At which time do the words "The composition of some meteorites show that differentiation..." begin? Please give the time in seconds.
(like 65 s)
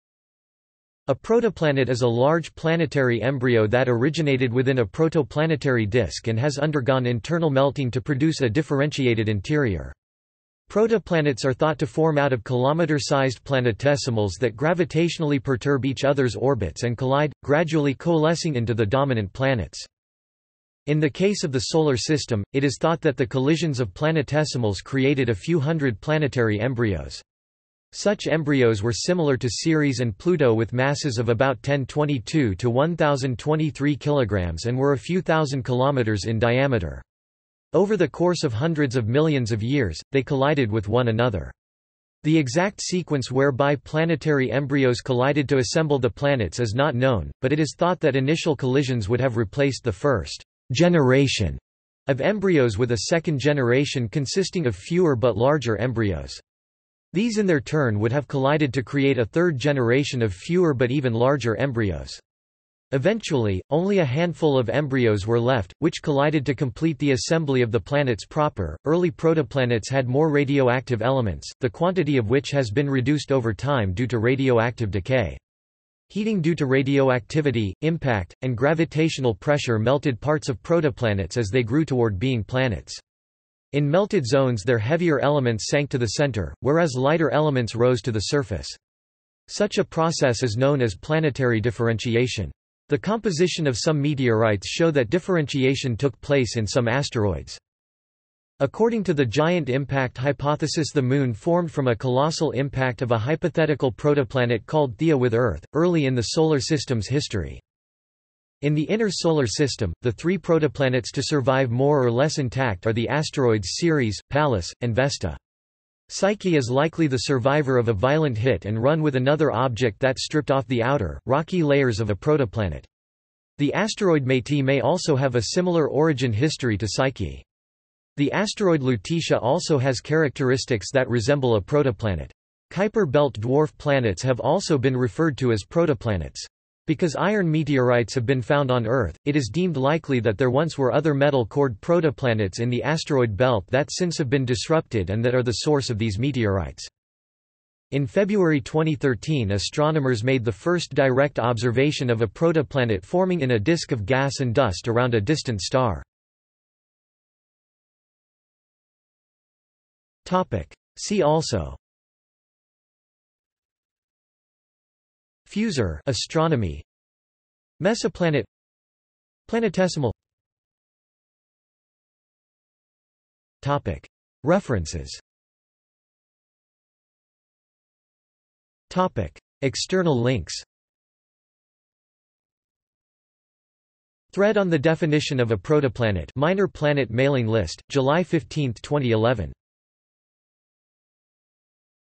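92 s.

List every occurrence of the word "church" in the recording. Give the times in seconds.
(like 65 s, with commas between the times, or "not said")
not said.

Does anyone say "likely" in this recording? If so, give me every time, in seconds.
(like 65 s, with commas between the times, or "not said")
116 s, 139 s.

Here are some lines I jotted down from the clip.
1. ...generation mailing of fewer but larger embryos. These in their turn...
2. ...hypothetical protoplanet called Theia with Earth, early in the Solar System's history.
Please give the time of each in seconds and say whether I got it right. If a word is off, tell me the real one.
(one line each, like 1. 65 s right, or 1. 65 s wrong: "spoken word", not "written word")
1. 53 s wrong: "consisting", not "mailing"
2. 103 s right.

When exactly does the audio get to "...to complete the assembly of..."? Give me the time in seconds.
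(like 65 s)
66 s.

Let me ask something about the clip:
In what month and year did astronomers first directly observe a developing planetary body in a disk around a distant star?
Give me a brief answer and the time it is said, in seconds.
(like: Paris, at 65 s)
February 2013, at 148 s.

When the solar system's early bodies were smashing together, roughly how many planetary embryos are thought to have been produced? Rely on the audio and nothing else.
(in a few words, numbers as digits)
a few hundred.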